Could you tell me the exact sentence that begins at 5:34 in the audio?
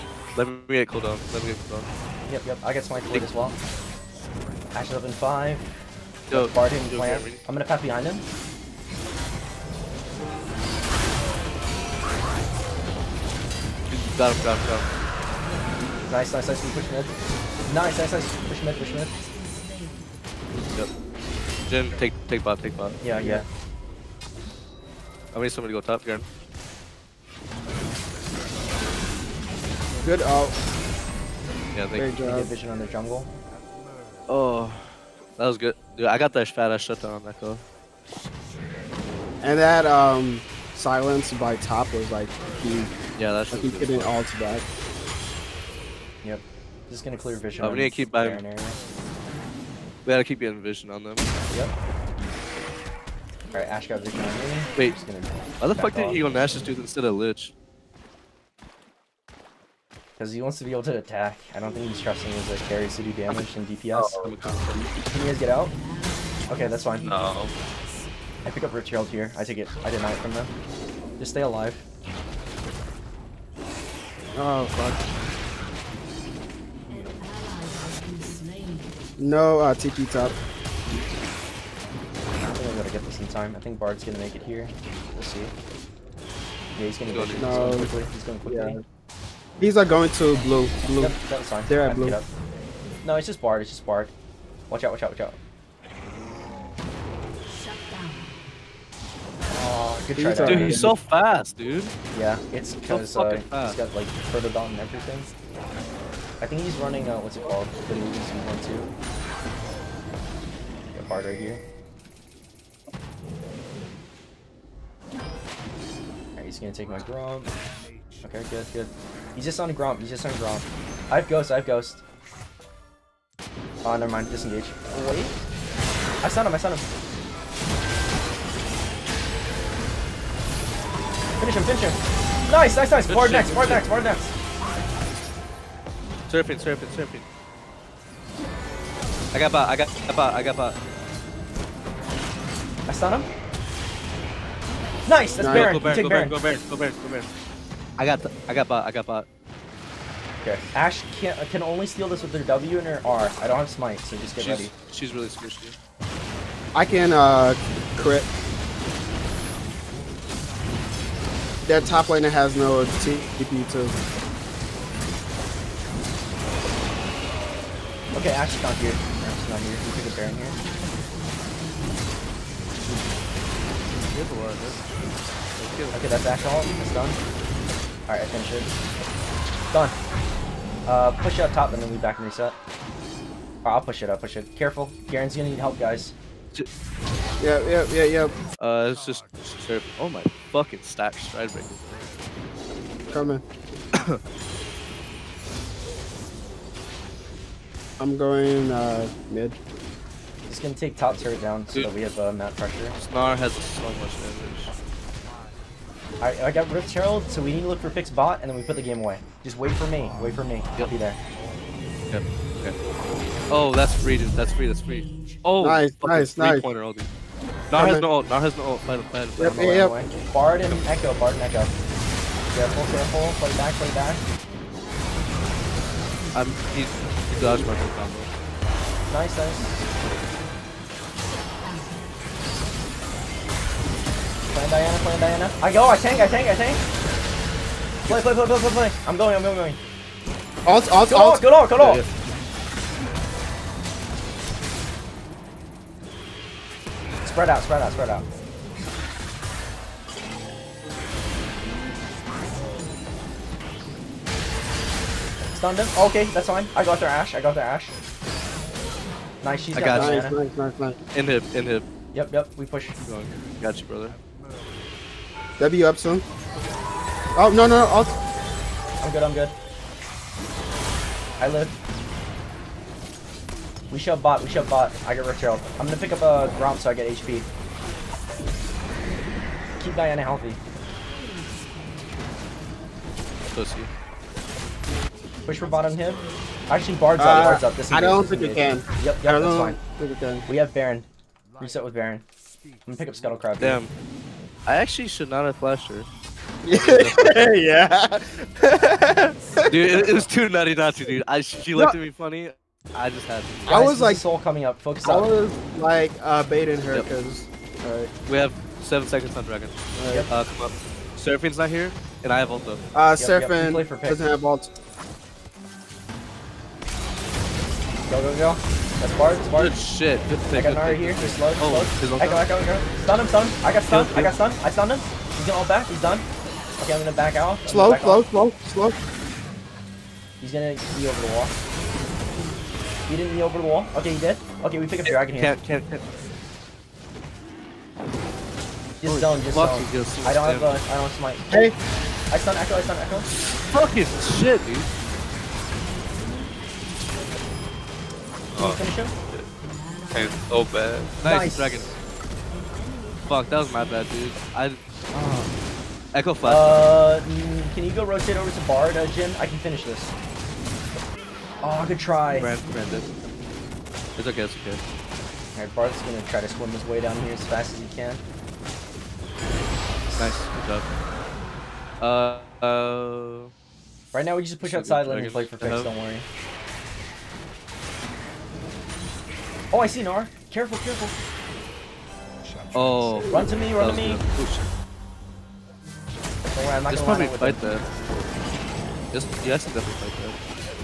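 Okay, we pick up Dragon here.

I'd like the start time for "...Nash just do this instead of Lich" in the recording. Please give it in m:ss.
0:56.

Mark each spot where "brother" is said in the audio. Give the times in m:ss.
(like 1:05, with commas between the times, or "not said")
4:23.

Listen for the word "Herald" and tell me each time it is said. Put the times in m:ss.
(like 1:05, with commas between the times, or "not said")
1:08, 3:26.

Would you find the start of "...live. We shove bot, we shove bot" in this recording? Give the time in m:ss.
4:31.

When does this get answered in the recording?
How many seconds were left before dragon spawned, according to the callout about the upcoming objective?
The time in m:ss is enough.
5:08.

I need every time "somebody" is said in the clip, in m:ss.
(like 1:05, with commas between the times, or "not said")
0:25.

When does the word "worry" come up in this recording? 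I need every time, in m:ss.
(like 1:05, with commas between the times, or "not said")
6:15.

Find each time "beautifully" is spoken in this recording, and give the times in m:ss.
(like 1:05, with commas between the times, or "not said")
not said.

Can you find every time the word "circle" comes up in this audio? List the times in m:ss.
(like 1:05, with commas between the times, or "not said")
not said.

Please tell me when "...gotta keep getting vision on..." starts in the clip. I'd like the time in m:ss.
0:50.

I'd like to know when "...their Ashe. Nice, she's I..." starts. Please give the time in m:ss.
4:17.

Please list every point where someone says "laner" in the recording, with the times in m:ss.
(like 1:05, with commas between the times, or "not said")
2:42.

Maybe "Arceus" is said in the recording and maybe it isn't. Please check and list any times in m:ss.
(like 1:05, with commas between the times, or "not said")
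not said.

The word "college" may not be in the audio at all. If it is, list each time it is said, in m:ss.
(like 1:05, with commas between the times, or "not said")
not said.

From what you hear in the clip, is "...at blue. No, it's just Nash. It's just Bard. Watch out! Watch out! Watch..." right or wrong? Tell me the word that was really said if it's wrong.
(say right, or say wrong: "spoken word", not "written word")
wrong: "Bard", not "Nash".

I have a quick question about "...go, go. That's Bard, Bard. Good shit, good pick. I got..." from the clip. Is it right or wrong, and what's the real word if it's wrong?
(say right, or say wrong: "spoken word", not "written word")
right.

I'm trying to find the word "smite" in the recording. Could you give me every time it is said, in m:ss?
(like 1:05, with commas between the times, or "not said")
0:02, 2:33, 5:41.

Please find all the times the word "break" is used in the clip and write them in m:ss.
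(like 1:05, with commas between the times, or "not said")
3:11.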